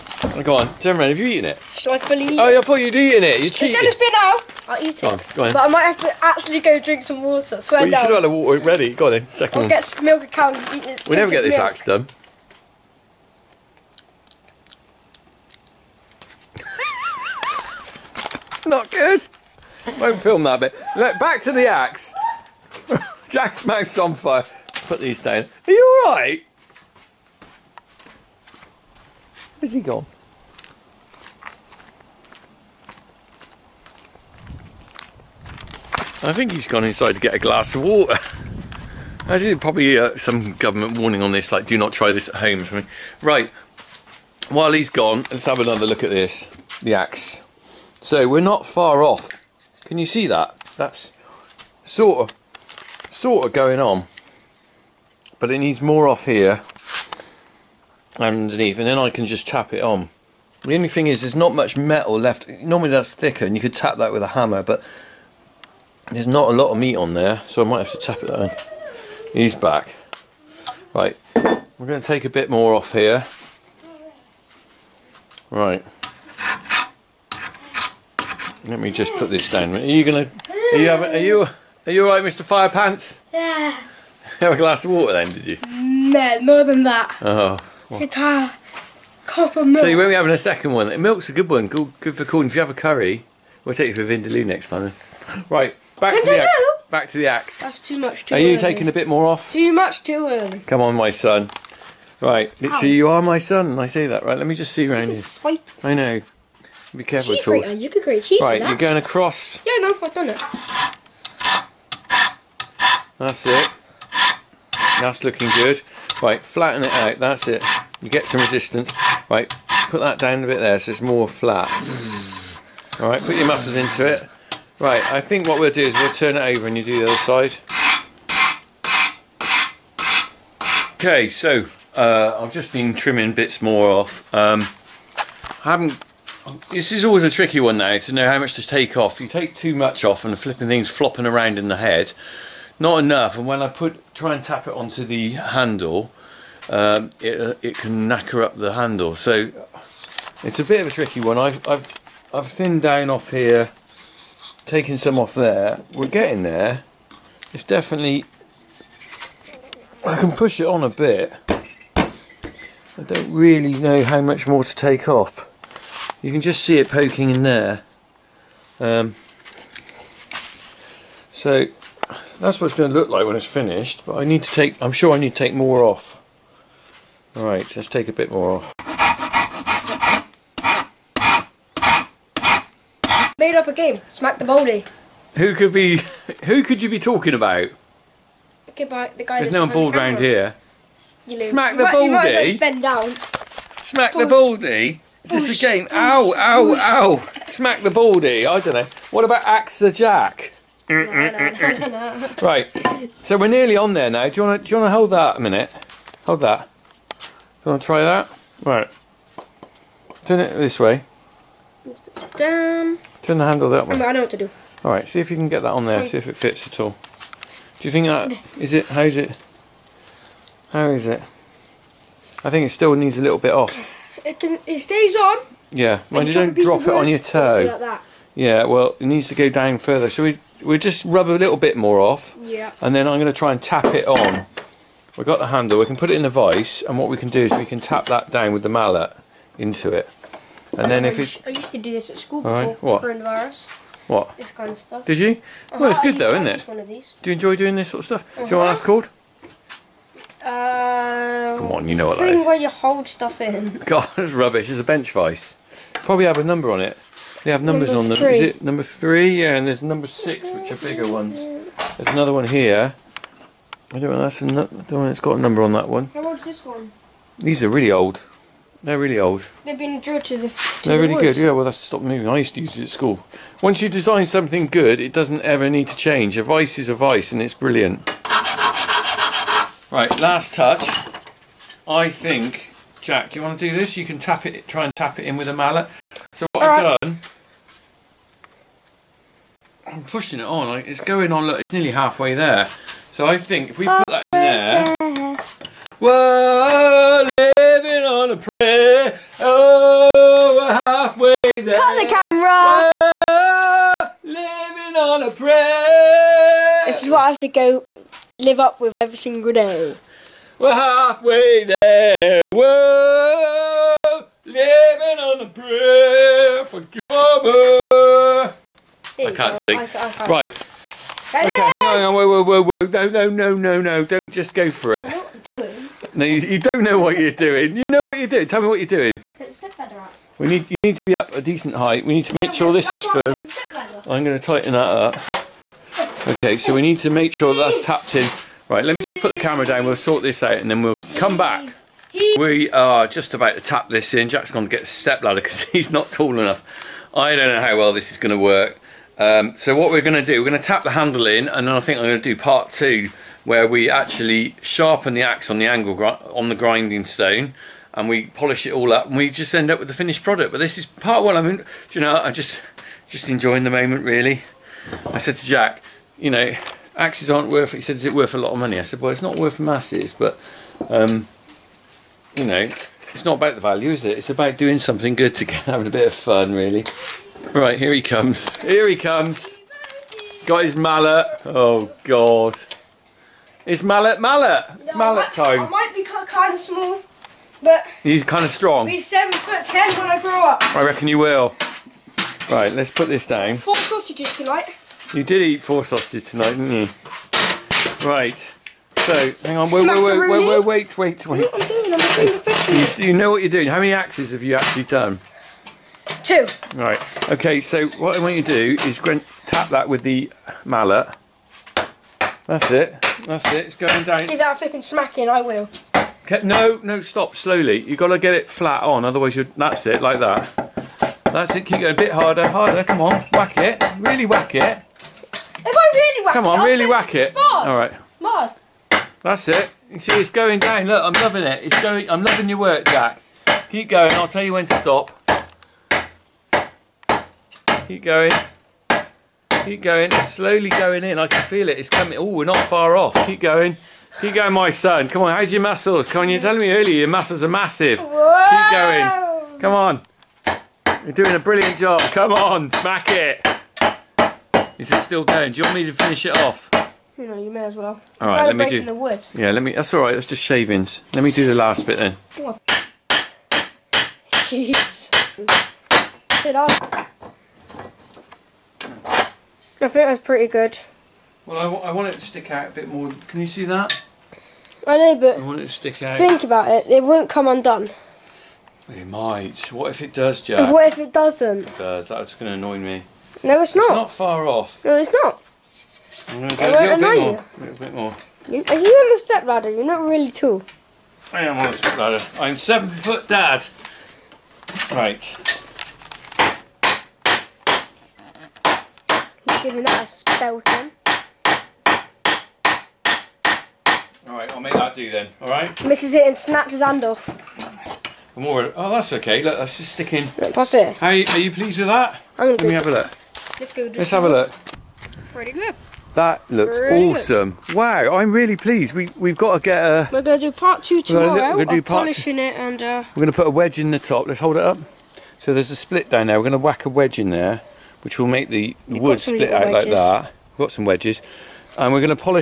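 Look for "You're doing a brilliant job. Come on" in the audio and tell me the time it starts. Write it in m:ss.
7:31.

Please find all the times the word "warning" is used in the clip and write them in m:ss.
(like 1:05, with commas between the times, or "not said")
0:40.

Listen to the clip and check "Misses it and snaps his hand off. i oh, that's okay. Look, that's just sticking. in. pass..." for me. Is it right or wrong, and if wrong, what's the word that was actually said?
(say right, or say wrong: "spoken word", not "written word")
right.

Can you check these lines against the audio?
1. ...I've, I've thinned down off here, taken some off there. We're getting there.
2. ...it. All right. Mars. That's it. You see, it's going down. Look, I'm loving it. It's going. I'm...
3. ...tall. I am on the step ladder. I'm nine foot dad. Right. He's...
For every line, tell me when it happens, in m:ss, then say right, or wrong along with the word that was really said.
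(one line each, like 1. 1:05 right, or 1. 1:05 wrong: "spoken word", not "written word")
1. 2:31 right
2. 7:07 right
3. 8:10 wrong: "seven", not "nine".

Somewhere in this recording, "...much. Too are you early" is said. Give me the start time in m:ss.
1:37.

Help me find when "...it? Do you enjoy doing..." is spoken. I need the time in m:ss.
4:06.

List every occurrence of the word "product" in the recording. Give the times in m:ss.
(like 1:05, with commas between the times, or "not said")
6:00.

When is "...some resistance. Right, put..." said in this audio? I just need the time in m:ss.
1:58.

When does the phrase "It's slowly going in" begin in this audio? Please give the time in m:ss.
7:20.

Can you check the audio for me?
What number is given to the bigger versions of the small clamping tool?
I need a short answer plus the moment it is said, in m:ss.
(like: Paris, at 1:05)
6, at 4:19.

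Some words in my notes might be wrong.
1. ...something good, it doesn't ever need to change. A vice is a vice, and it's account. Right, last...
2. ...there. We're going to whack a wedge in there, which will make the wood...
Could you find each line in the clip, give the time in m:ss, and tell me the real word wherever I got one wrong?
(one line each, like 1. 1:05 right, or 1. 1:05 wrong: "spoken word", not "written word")
1. 4:34 wrong: "brilliant", not "account"
2. 8:46 right.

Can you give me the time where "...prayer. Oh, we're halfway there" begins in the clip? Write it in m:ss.
4:58.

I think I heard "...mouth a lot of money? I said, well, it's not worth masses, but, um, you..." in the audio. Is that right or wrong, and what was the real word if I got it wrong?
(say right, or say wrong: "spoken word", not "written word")
wrong: "worth", not "mouth".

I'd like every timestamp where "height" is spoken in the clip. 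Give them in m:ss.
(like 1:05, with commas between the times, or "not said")
5:31.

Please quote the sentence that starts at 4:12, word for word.
thing where you hold stuff in.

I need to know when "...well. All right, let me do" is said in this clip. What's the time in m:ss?
7:37.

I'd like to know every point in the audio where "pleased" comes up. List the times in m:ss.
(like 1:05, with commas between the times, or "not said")
8:31, 8:38.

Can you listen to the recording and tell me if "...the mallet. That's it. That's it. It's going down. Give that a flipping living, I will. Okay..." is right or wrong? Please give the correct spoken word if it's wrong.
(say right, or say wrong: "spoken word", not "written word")
wrong: "smacking", not "living".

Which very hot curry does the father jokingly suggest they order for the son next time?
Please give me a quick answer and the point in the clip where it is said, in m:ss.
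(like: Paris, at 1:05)
Vindaloo, at 1:34.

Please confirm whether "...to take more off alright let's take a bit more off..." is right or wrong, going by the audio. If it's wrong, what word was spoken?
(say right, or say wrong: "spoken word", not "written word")
right.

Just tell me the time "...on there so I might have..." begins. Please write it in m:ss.
1:06.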